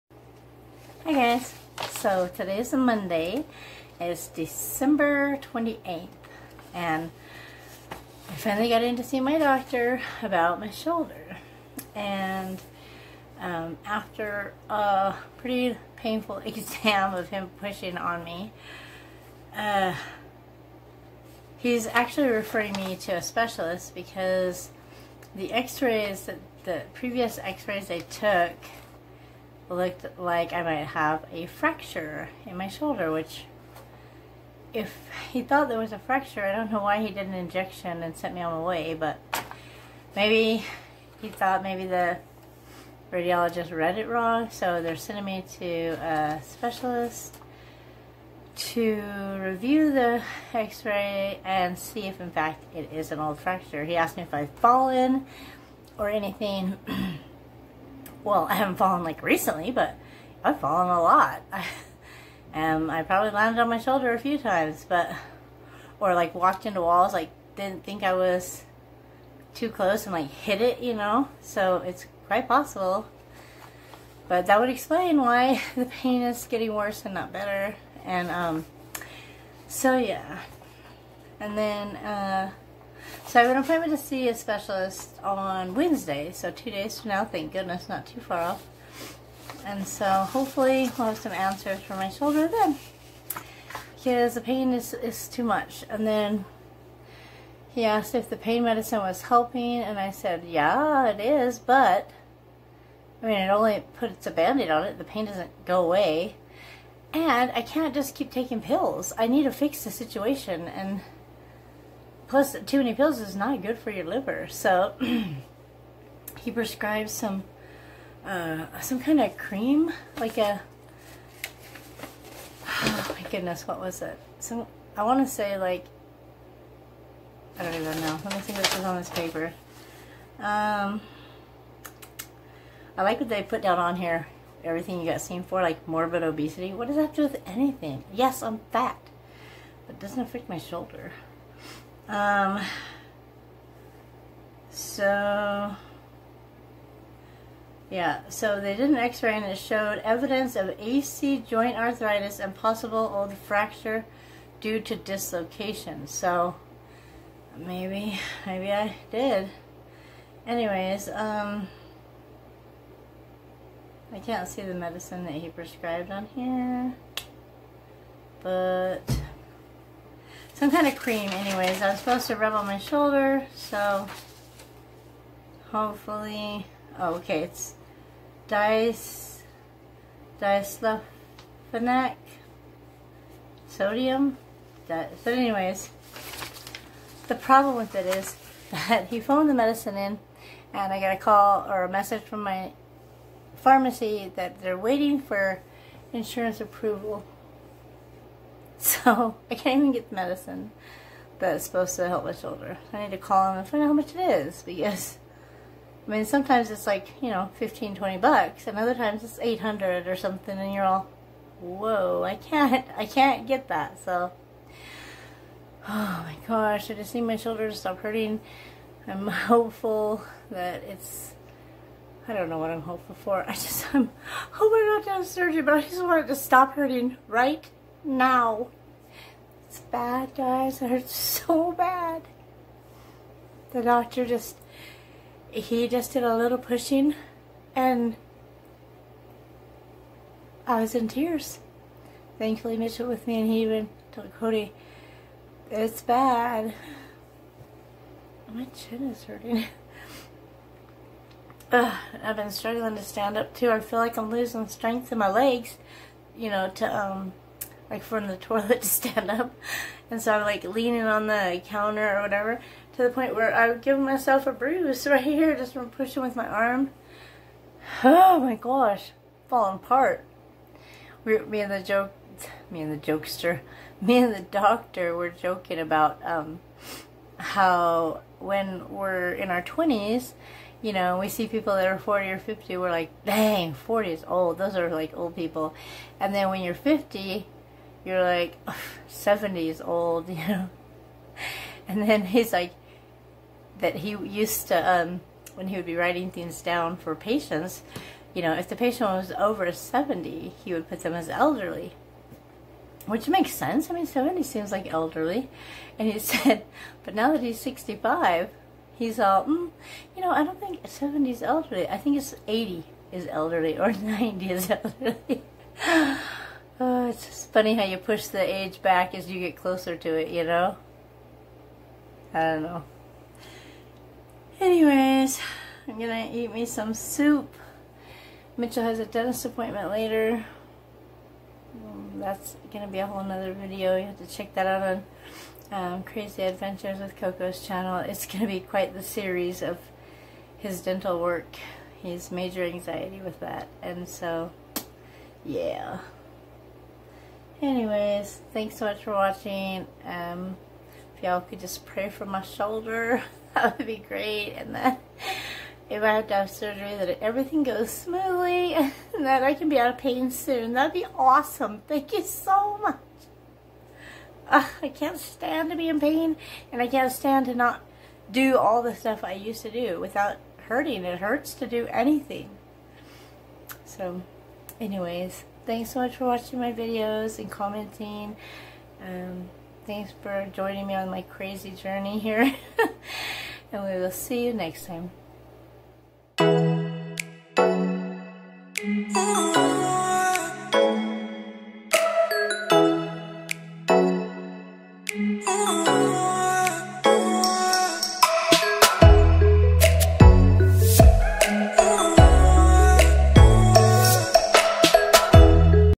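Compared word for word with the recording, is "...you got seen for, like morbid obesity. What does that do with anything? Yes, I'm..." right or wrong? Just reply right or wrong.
right.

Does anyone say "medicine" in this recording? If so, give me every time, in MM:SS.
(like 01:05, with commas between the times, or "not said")
01:38, 02:44, 03:09, 03:20.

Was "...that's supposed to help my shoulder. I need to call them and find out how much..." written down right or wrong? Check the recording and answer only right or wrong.
right.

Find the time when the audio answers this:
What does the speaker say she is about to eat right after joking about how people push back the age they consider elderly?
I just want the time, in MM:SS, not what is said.
05:26.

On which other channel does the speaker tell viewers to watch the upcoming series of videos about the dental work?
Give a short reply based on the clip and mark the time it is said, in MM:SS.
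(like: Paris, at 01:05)
Crazy Adventures with Coco, at 05:36.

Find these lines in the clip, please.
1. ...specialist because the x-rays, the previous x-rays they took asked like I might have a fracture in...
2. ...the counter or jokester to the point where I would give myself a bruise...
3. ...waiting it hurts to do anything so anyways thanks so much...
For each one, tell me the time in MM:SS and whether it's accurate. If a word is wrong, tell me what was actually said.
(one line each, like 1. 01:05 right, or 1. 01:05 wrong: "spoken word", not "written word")
1. 00:23 wrong: "looked", not "asked"
2. 04:21 wrong: "whatever", not "jokester"
3. 06:10 wrong: "hurting", not "waiting".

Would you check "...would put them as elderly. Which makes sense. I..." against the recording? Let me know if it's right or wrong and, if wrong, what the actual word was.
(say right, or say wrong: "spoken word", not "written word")
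right.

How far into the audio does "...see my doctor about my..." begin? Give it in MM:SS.
00:09.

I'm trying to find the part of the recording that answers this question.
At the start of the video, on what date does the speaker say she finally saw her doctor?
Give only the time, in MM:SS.
00:04.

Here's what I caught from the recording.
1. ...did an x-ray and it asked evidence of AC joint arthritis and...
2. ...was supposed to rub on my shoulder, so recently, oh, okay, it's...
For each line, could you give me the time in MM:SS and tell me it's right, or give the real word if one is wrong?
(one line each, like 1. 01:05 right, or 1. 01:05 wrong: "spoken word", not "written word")
1. 02:28 wrong: "showed", not "asked"
2. 02:51 wrong: "hopefully", not "recently".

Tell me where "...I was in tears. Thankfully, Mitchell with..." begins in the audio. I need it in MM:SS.
04:00.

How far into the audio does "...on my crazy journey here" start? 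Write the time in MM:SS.
06:20.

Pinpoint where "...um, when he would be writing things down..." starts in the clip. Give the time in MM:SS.
04:54.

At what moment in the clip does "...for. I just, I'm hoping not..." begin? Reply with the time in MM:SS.
03:43.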